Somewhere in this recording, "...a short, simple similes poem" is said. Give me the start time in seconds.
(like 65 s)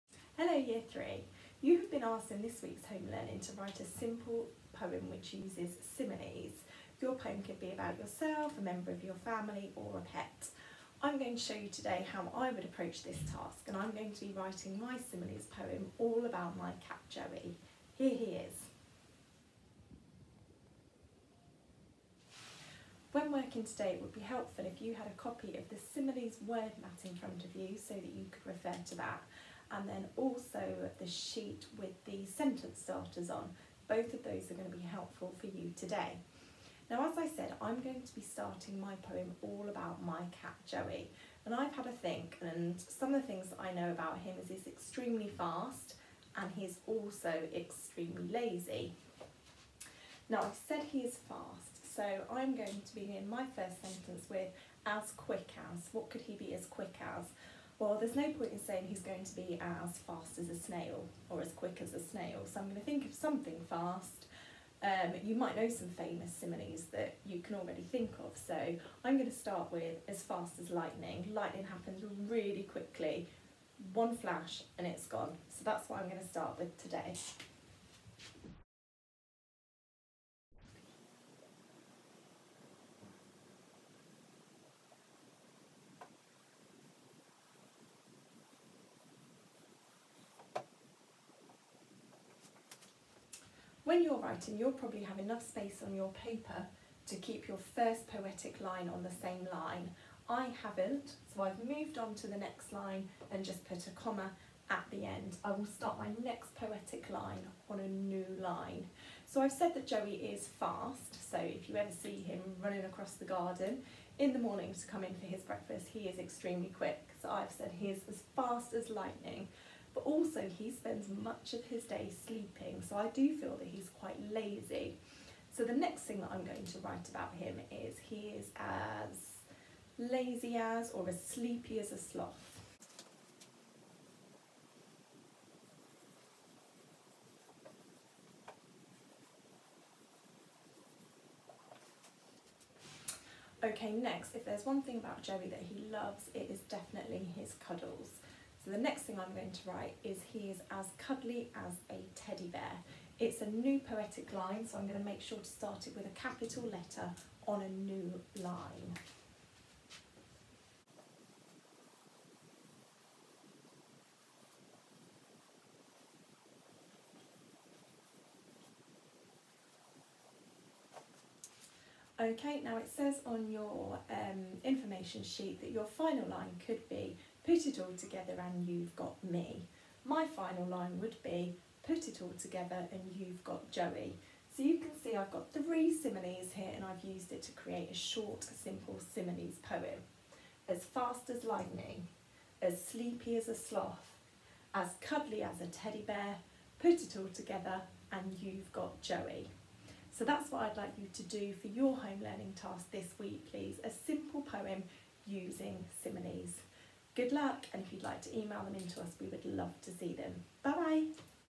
187 s.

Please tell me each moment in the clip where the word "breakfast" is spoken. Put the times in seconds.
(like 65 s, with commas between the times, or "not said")
115 s.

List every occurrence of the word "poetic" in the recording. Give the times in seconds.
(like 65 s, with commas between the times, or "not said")
98 s, 106 s, 153 s.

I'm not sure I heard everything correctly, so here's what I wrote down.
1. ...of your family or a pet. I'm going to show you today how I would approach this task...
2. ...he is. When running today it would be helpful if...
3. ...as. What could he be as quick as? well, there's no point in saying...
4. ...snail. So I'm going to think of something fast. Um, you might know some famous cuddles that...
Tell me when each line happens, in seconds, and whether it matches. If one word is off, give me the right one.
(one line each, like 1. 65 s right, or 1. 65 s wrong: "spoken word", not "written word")
1. 8 s right
2. 18 s wrong: "working", not "running"
3. 55 s right
4. 61 s wrong: "similes", not "cuddles".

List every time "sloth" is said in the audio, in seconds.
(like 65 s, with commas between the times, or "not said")
131 s, 193 s.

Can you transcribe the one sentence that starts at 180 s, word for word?
My final line would be, put it all together and you've got Joey.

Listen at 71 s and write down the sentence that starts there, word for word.
Lightning happens really quickly, one flash and it's gone.